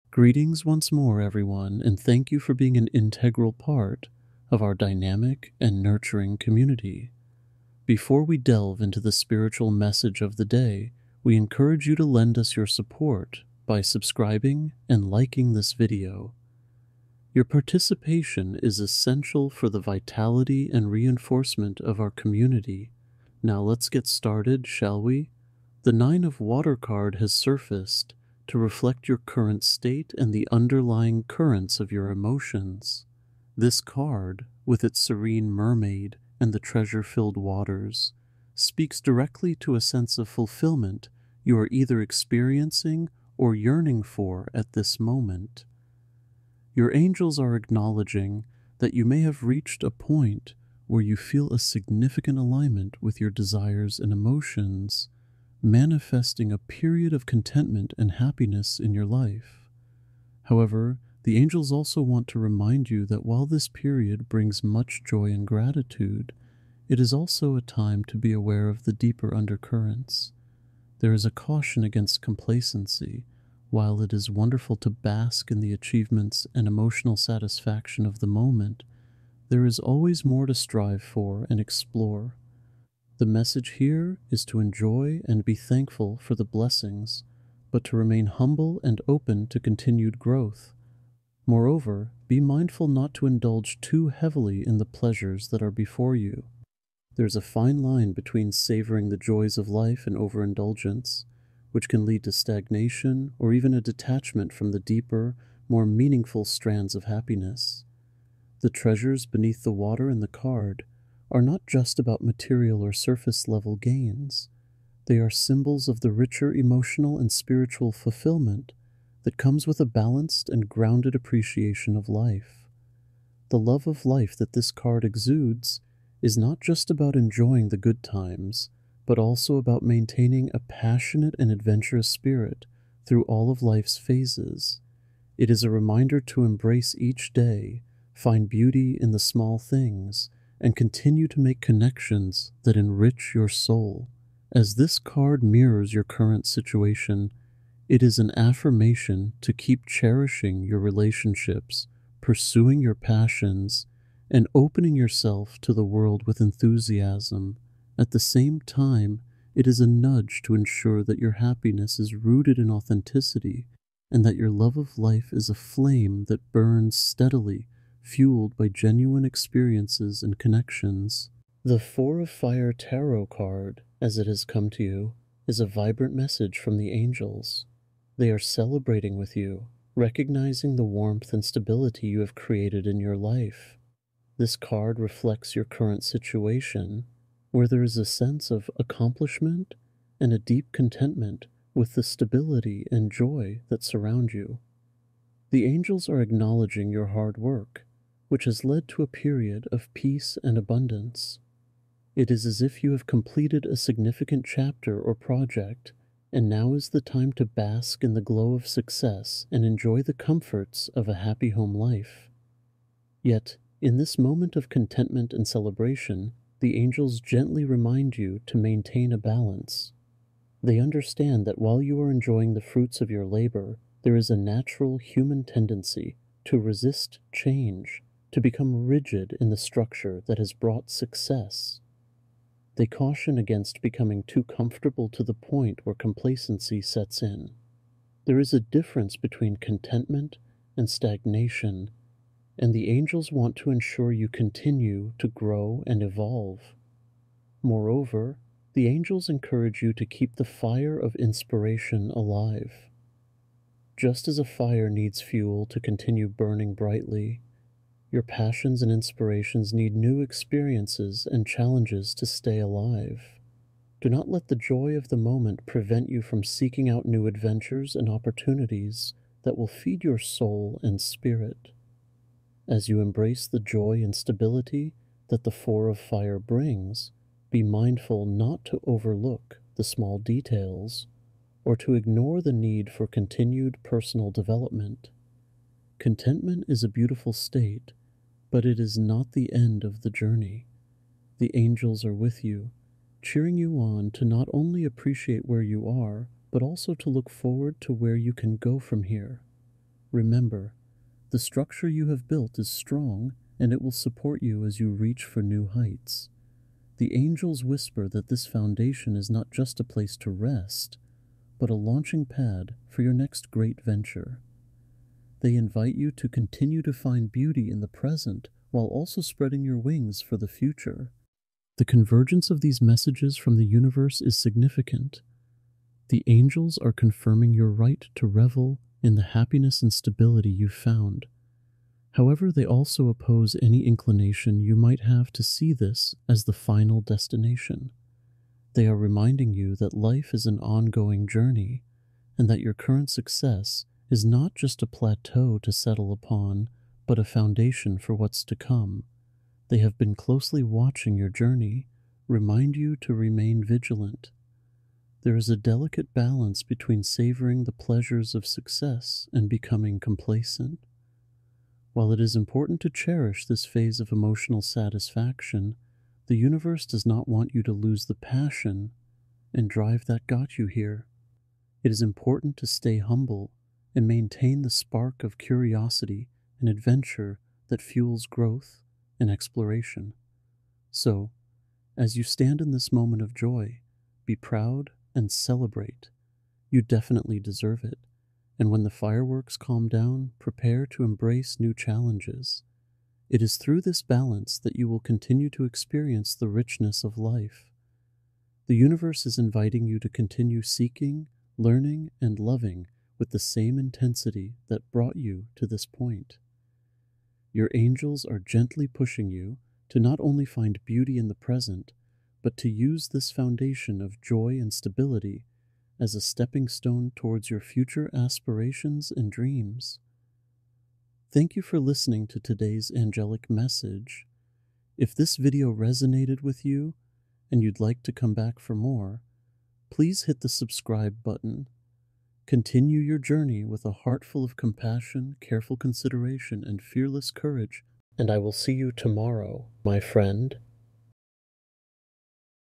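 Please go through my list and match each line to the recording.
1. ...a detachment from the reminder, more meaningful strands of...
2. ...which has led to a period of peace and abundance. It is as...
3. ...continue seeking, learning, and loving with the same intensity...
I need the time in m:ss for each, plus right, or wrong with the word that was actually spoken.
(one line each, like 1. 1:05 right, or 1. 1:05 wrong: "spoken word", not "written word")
1. 1:43 wrong: "deeper", not "reminder"
2. 3:18 right
3. 6:40 right.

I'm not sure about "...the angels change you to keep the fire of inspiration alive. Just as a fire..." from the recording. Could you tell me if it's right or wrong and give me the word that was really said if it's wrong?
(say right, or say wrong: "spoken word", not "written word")
wrong: "encourage", not "change".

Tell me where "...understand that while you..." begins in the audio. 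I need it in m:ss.
3:40.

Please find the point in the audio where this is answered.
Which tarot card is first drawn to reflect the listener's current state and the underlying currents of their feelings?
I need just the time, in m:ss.
0:25.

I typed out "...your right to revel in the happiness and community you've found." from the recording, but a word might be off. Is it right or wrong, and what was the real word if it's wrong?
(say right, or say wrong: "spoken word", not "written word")
wrong: "stability", not "community".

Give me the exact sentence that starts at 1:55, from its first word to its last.
They are symbols of the richer emotional and spiritual fulfillment that comes with a balanced and grounded appreciation of life.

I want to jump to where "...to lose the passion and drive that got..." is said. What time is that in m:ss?
6:07.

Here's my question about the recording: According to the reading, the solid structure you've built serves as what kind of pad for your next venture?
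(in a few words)
launching pad.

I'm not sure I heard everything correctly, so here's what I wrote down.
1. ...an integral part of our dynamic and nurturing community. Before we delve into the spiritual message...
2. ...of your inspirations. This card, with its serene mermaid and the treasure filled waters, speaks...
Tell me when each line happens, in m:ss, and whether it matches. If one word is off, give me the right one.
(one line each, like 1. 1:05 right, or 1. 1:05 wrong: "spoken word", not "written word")
1. 0:02 right
2. 0:31 wrong: "emotions", not "inspirations".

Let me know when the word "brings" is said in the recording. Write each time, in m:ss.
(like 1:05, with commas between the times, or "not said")
1:04, 4:36.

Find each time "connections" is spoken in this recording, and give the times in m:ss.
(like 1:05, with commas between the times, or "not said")
2:21, 2:50.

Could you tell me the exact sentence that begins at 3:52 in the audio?
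They caution against becoming too comfortable to the point where complacency sets in.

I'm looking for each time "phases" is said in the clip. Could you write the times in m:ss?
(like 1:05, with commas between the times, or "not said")
2:13, 6:03.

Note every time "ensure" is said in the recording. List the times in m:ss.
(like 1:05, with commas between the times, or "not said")
2:40, 4:03.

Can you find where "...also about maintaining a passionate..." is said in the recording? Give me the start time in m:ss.
2:09.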